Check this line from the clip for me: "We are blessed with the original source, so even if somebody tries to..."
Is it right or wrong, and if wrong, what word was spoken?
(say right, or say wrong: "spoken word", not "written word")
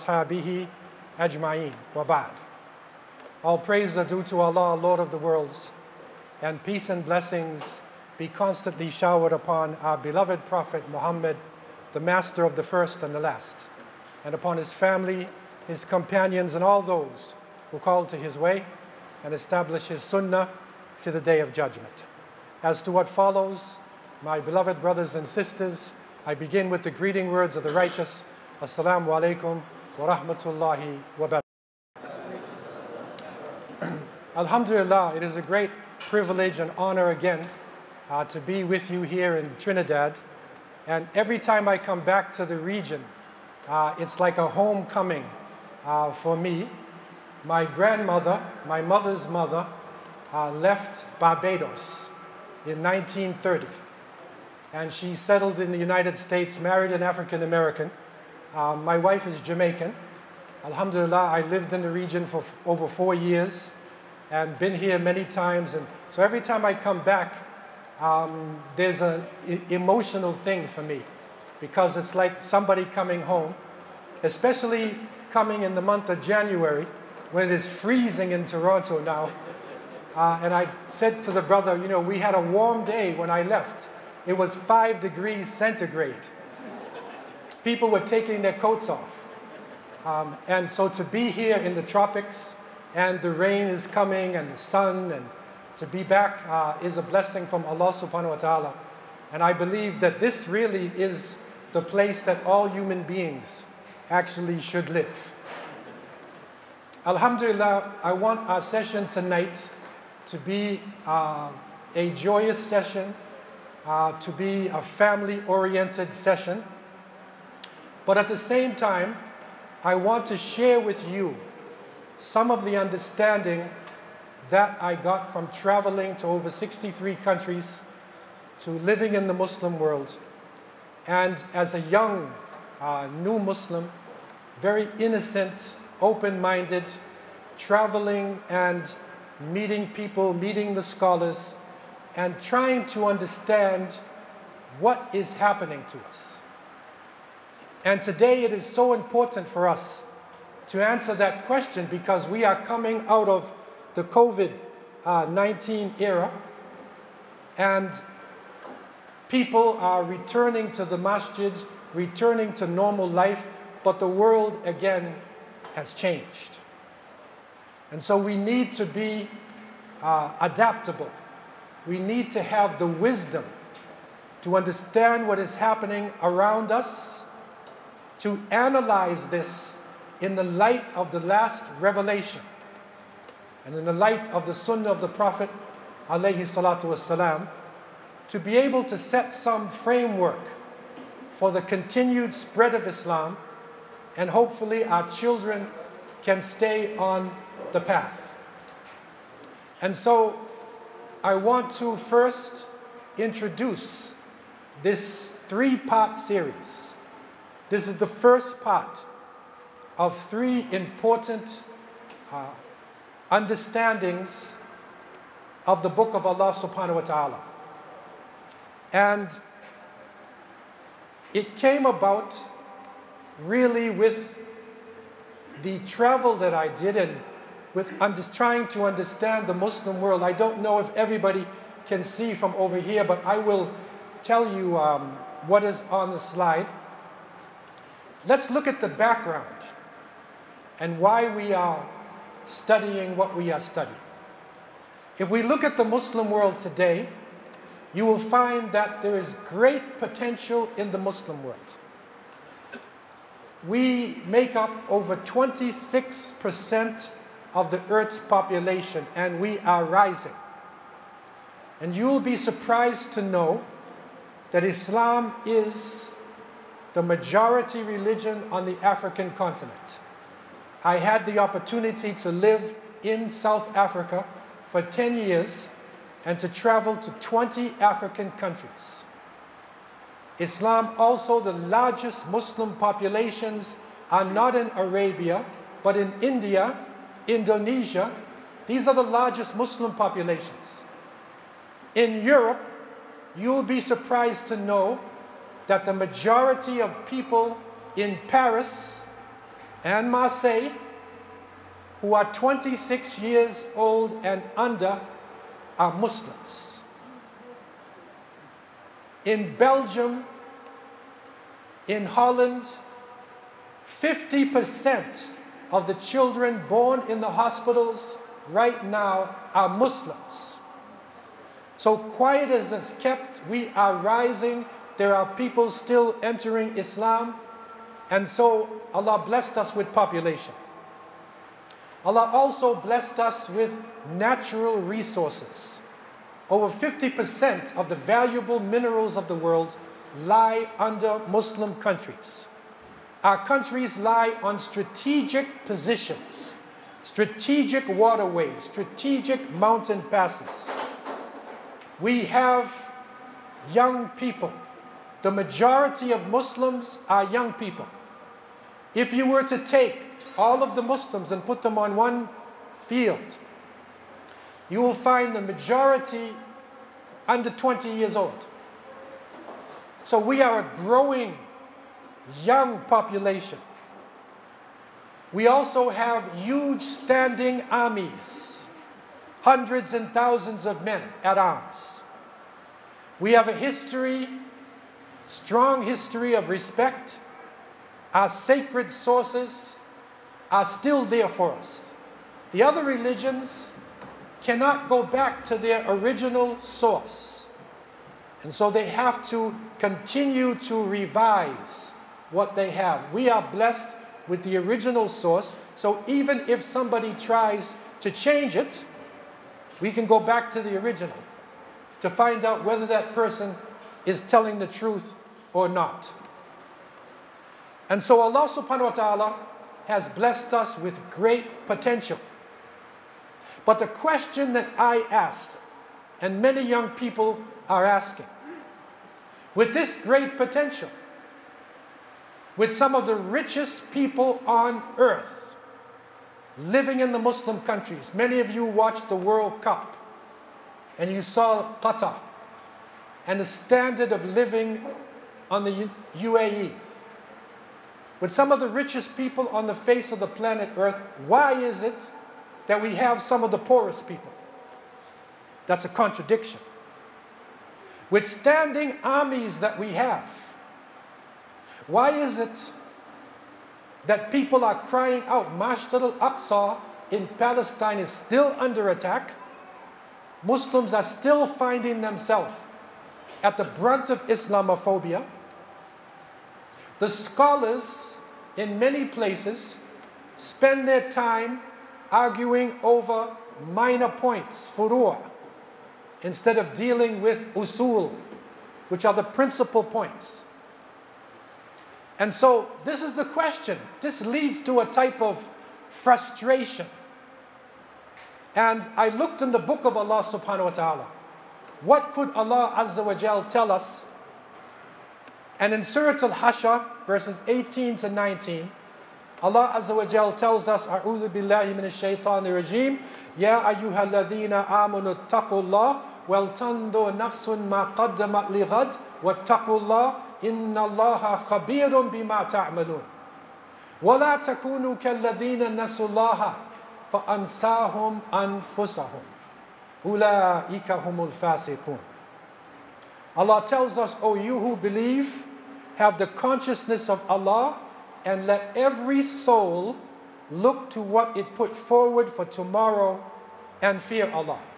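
right.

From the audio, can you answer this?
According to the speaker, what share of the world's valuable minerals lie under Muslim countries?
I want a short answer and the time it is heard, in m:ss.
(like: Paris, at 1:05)
Over 50%, at 5:36.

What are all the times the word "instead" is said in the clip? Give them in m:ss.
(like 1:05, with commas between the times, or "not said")
8:06.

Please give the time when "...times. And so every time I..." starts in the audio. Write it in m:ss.
1:05.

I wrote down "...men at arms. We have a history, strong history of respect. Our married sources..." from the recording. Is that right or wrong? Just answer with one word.
wrong.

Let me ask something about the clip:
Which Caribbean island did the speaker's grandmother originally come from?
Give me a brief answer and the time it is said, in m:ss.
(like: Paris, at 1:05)
Barbados, at 0:51.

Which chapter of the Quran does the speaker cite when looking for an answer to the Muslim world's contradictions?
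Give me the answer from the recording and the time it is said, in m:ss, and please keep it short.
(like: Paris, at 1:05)
Surah Al-Hashr, at 8:25.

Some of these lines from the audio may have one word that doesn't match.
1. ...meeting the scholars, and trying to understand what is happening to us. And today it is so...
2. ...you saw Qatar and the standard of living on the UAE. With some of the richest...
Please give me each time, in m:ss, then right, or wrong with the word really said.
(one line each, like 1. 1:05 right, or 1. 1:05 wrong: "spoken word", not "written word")
1. 2:20 right
2. 7:21 right.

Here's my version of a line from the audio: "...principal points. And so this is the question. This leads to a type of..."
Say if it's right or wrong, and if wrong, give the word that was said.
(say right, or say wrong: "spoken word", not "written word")
right.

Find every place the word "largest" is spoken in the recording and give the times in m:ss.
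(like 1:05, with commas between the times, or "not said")
4:41, 4:49.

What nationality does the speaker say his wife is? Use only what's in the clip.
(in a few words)
Jamaican.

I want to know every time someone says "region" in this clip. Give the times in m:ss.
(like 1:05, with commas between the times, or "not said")
0:42, 1:01.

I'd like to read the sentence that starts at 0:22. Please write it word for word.
As to what follows, my beloved brothers and sisters, I begin with the greeting words of the righteous.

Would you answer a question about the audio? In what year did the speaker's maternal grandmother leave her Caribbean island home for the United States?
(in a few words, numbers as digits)
1930.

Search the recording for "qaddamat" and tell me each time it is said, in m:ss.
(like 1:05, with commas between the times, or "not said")
8:37.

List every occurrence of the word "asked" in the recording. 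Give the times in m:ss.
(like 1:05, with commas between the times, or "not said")
7:05.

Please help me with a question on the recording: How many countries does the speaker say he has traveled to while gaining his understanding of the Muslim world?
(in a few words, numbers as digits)
63.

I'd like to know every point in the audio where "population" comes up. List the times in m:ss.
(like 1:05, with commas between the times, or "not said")
4:18, 4:42, 4:49, 5:29, 6:12.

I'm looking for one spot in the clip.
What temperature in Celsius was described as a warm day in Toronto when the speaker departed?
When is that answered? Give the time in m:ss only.
1:24.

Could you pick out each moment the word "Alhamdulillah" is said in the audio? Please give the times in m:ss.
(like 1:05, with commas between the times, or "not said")
0:34, 1:00, 1:47.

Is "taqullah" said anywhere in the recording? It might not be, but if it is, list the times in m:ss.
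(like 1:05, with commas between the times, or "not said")
8:35, 8:39.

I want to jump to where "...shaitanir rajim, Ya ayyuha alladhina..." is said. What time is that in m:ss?
8:31.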